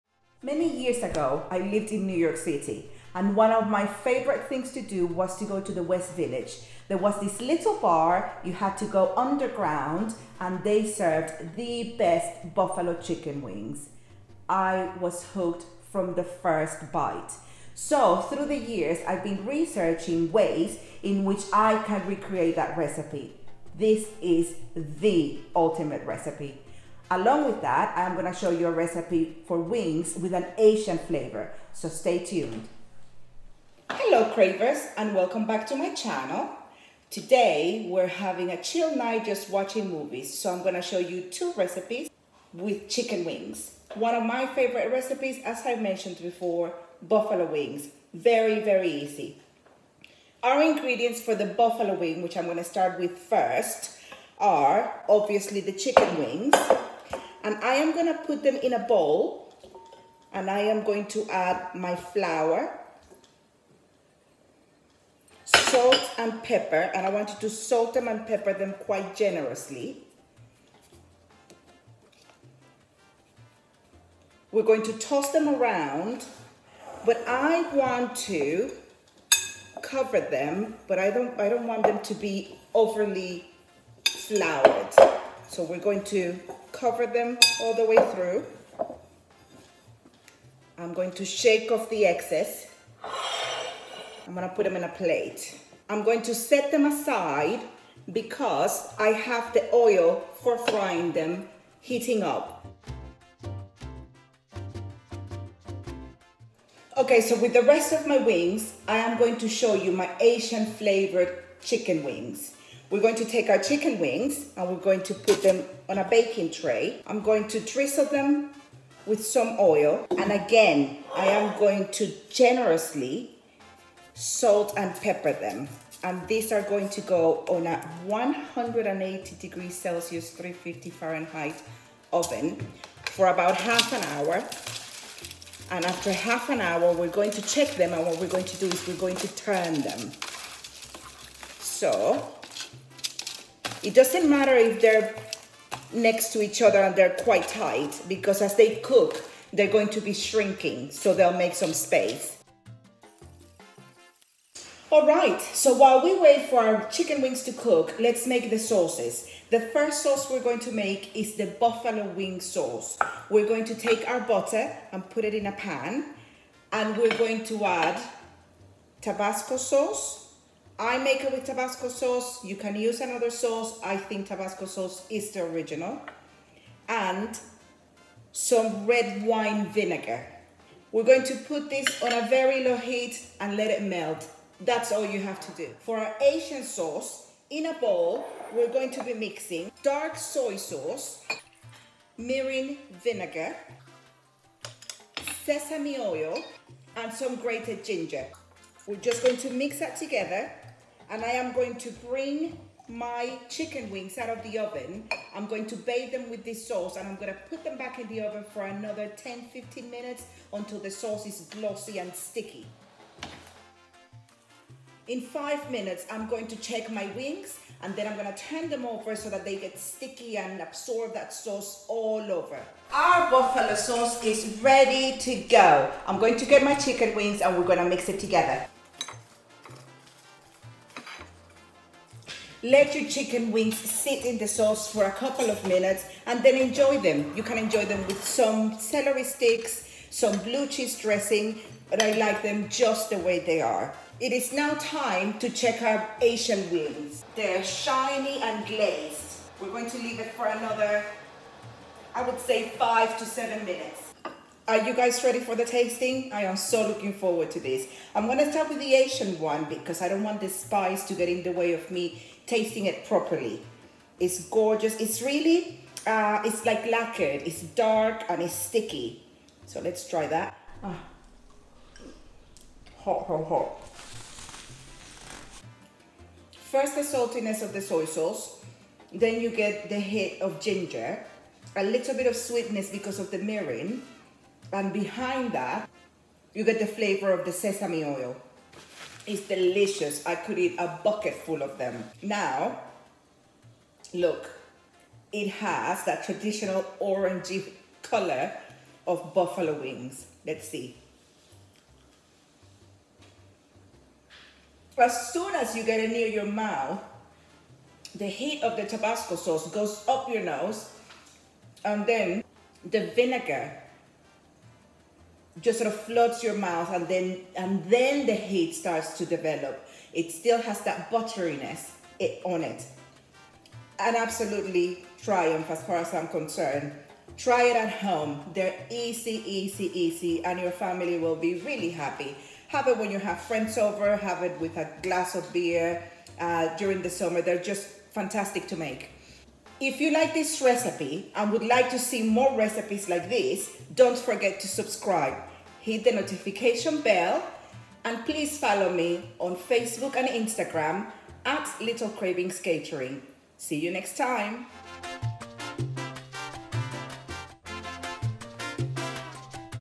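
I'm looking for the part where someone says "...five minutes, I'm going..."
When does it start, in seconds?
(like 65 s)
215 s.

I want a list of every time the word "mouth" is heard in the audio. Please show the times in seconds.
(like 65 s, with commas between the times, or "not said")
306 s, 316 s.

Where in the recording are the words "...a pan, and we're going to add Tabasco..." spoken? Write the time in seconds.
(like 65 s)
165 s.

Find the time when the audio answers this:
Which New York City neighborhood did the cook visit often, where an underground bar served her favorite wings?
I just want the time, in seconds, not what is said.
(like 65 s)
5 s.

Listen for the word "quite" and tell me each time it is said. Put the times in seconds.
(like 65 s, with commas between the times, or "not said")
68 s, 147 s.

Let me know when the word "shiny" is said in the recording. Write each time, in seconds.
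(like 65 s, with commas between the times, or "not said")
247 s.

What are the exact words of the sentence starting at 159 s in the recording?
The first sauce we're going to make is the buffalo wing sauce.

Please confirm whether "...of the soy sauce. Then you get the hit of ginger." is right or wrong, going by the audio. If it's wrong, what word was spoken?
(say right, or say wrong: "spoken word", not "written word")
right.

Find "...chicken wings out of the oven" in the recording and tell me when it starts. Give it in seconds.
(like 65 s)
203 s.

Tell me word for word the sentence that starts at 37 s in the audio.
Today we're having a chill night just watching movies, so I'm gonna show you two recipes with chicken wings.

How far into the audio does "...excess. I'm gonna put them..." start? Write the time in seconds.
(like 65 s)
92 s.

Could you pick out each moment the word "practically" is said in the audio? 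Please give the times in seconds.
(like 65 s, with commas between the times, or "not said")
not said.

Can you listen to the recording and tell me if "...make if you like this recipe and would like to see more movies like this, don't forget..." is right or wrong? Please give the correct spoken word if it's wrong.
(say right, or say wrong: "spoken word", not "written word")
wrong: "recipes", not "movies".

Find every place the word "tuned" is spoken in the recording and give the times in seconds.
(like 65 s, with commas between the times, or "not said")
32 s.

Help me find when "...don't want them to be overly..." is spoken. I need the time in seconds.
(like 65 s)
81 s.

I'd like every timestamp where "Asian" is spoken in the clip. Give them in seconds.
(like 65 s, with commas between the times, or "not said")
30 s, 110 s, 186 s, 246 s, 258 s.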